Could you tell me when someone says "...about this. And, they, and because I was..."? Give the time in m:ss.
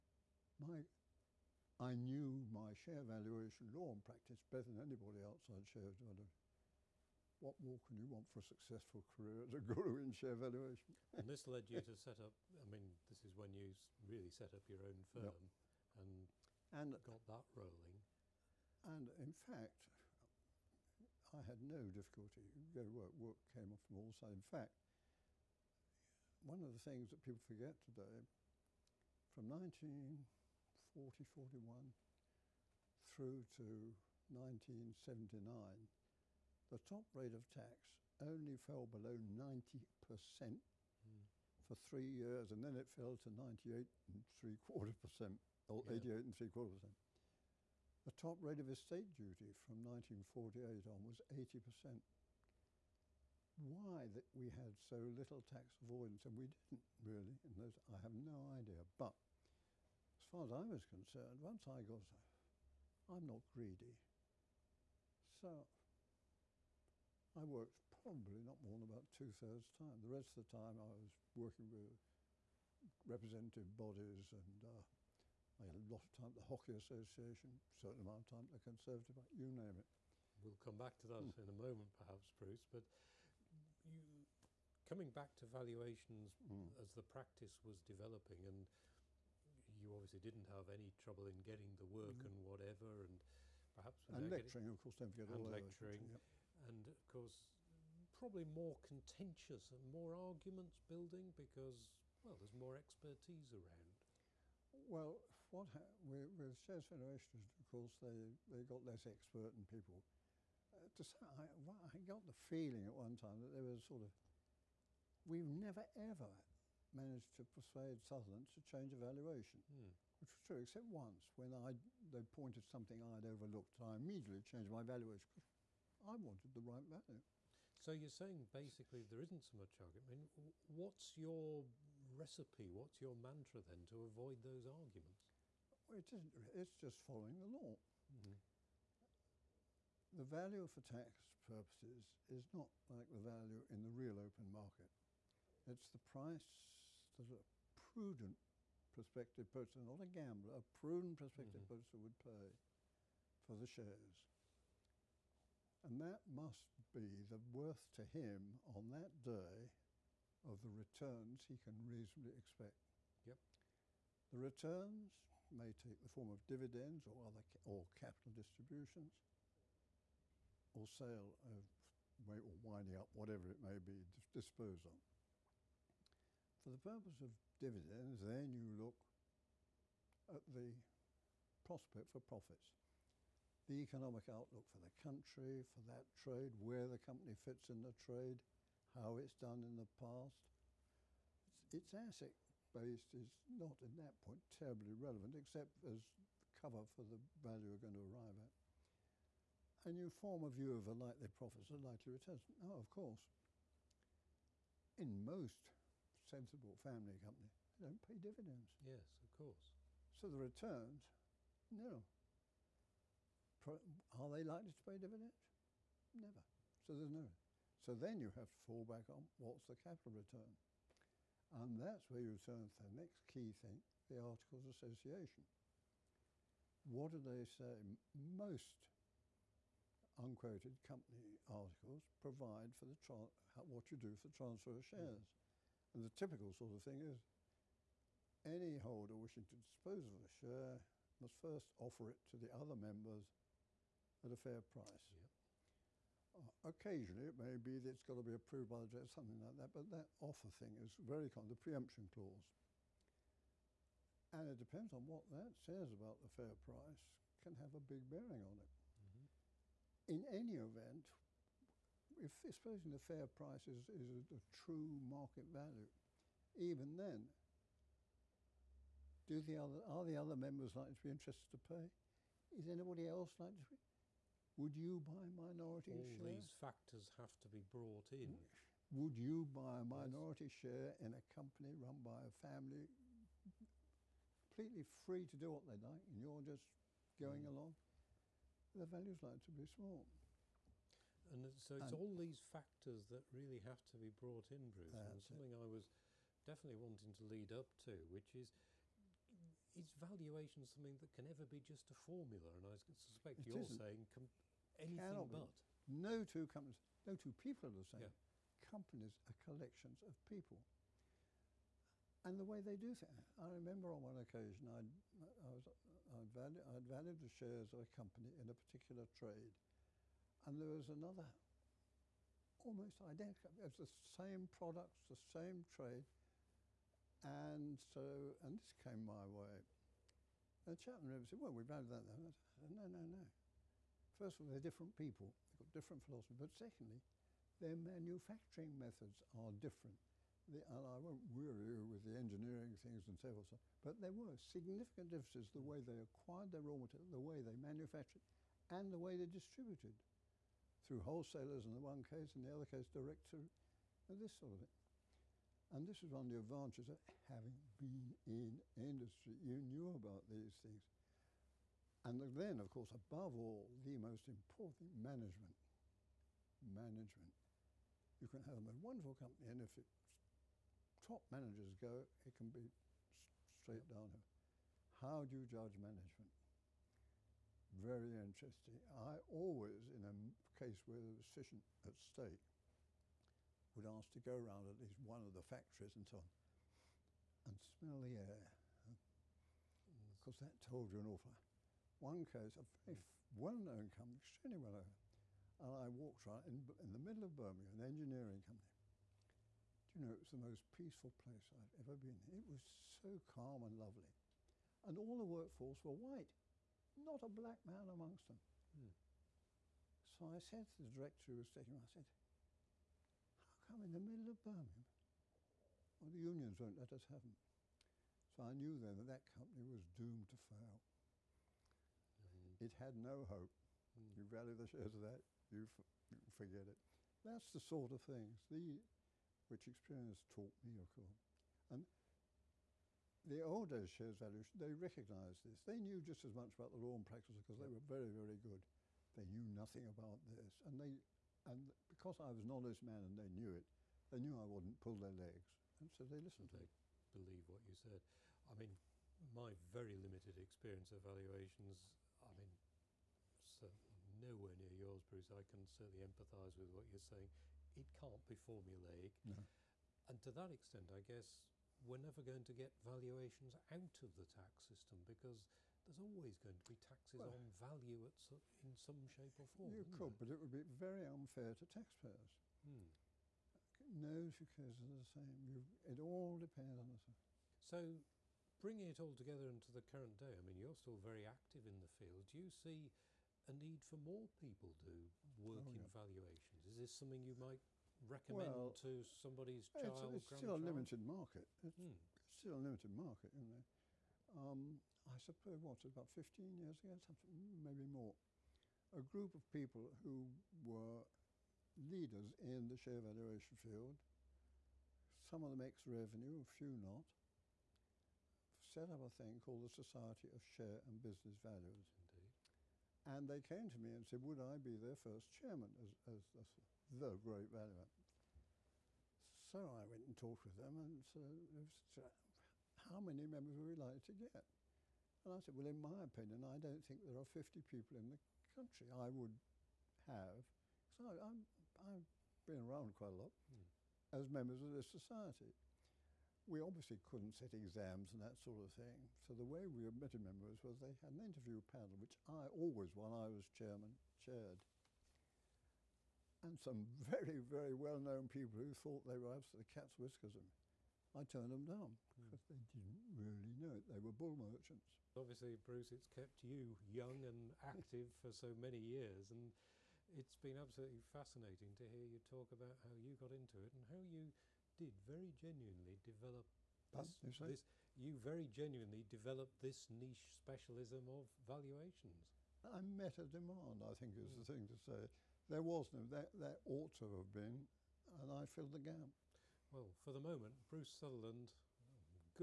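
7:19.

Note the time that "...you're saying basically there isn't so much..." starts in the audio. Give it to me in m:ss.
2:07.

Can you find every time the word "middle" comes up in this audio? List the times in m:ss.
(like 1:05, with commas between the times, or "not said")
6:36, 6:53.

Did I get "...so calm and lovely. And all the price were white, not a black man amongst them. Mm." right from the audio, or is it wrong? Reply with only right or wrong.
wrong.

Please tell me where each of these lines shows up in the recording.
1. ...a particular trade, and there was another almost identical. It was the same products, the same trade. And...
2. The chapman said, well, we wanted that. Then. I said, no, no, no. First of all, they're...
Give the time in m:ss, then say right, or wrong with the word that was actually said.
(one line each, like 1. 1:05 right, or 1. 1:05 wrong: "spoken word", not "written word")
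1. 5:18 right
2. 5:30 wrong: "valued", not "wanted".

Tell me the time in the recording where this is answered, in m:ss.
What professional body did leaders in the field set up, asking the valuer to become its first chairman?
8:29.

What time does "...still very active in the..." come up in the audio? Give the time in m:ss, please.
8:00.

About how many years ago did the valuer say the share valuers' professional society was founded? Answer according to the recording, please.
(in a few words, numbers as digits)
15 years.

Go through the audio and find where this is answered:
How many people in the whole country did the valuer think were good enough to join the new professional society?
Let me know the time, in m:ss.
8:47.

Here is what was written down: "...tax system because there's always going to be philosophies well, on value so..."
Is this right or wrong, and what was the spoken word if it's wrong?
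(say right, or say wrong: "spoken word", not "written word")
wrong: "taxes", not "philosophies".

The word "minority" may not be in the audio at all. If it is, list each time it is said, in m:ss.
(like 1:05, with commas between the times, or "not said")
4:35, 4:39.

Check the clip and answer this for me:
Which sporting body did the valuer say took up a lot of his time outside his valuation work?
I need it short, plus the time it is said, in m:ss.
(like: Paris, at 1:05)
The Hockey Association, at 1:16.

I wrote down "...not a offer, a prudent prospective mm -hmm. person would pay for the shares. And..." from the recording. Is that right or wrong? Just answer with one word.
wrong.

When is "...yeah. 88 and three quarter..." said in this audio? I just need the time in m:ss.
0:45.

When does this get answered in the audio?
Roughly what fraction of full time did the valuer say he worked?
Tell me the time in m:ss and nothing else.
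1:09.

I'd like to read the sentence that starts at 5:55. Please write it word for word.
And this was one of the advantages of having been in industry.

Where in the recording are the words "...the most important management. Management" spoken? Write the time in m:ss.
6:03.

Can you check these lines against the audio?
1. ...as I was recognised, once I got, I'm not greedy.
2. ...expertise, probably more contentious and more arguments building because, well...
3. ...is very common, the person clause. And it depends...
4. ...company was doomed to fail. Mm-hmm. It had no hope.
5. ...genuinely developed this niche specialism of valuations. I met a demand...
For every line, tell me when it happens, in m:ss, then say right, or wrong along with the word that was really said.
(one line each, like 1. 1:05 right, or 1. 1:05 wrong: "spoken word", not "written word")
1. 1:00 wrong: "concerned", not "recognised"
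2. 1:37 wrong: "course", not "expertise"
3. 4:10 wrong: "preemption", not "person"
4. 6:59 right
5. 9:28 right.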